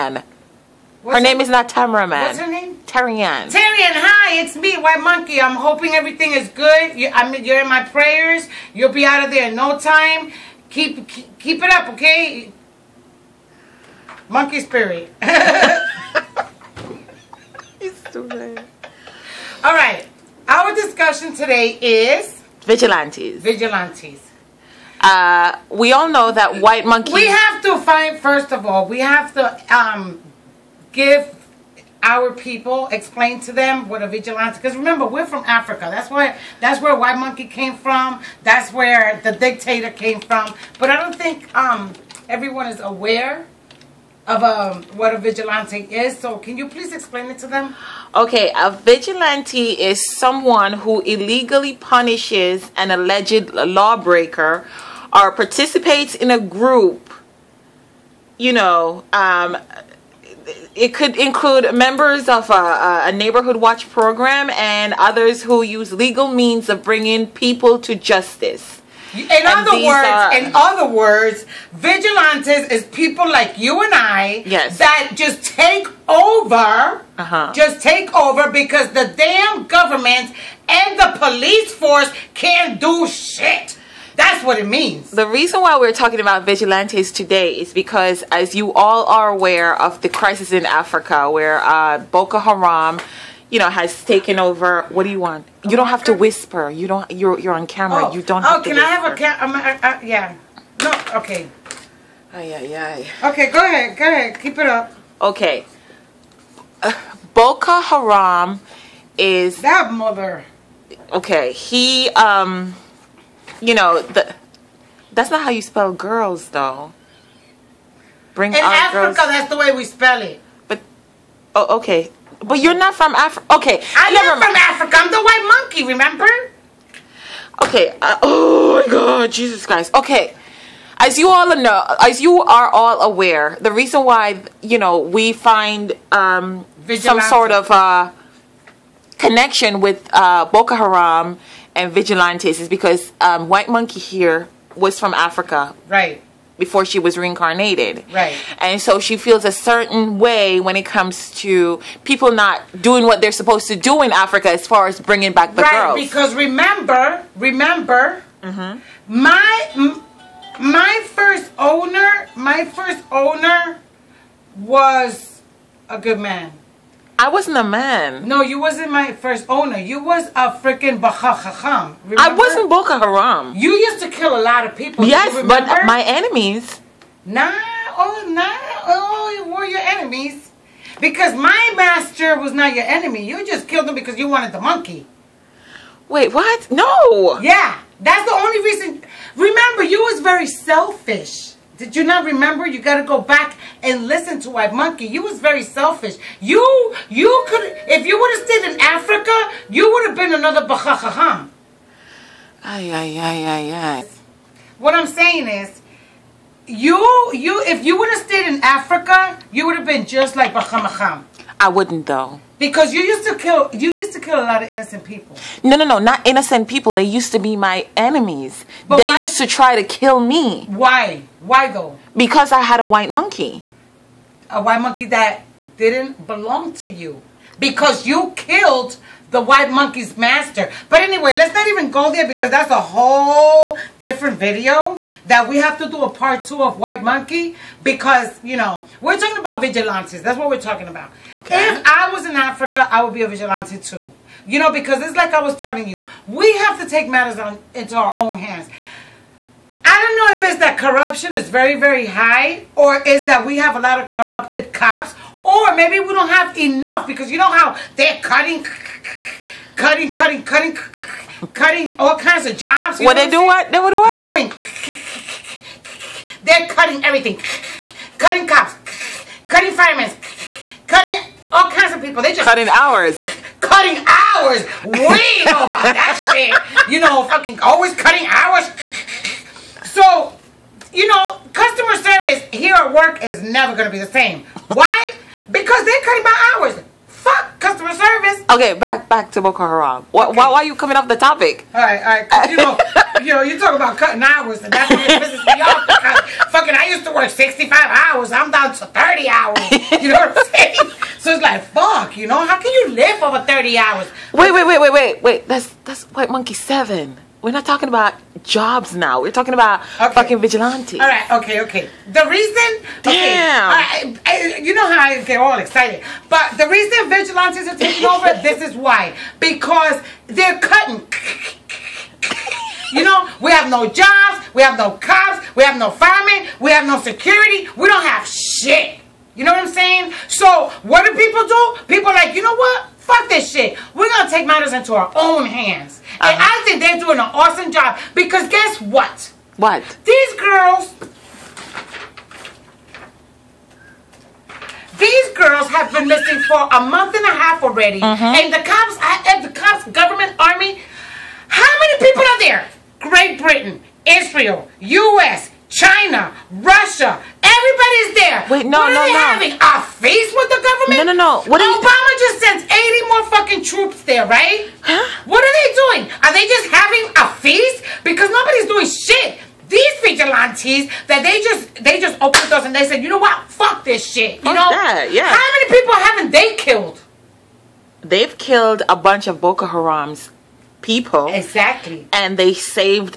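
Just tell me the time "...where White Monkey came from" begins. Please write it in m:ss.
0:36.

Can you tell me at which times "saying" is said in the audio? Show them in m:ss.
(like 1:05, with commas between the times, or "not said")
3:25, 5:00, 5:29.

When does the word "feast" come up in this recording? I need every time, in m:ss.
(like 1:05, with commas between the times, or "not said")
6:00, 6:07.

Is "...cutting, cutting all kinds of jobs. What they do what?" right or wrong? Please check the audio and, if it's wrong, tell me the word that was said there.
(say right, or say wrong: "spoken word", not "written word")
right.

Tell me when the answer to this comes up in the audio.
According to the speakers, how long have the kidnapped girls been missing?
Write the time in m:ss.
5:46.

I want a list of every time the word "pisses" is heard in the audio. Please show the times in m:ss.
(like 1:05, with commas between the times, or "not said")
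4:55.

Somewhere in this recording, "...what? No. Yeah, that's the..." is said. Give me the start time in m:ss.
3:06.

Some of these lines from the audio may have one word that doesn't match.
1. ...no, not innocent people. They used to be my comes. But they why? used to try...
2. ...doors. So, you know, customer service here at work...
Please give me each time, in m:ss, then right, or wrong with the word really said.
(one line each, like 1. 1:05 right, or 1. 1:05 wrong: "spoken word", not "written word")
1. 3:35 wrong: "enemies", not "comes"
2. 4:38 wrong: "hours", not "doors".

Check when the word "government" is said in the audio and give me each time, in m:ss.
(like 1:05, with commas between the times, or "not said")
1:19, 5:50, 6:00.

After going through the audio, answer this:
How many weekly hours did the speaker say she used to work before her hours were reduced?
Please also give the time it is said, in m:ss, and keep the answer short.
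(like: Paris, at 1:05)
65, at 4:57.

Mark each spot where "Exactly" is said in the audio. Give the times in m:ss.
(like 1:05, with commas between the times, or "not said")
6:21.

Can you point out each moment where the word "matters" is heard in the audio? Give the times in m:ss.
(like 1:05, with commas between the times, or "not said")
4:07, 5:34.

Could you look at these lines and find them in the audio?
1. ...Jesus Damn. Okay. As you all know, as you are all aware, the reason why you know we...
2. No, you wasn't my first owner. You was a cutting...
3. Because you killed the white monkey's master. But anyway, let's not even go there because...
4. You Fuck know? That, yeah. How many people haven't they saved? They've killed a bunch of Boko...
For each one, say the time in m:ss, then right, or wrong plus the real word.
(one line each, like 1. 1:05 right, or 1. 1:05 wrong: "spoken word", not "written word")
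1. 2:09 wrong: "Christ", not "Damn"
2. 2:48 wrong: "freaking", not "cutting"
3. 3:47 right
4. 6:14 wrong: "killed", not "saved".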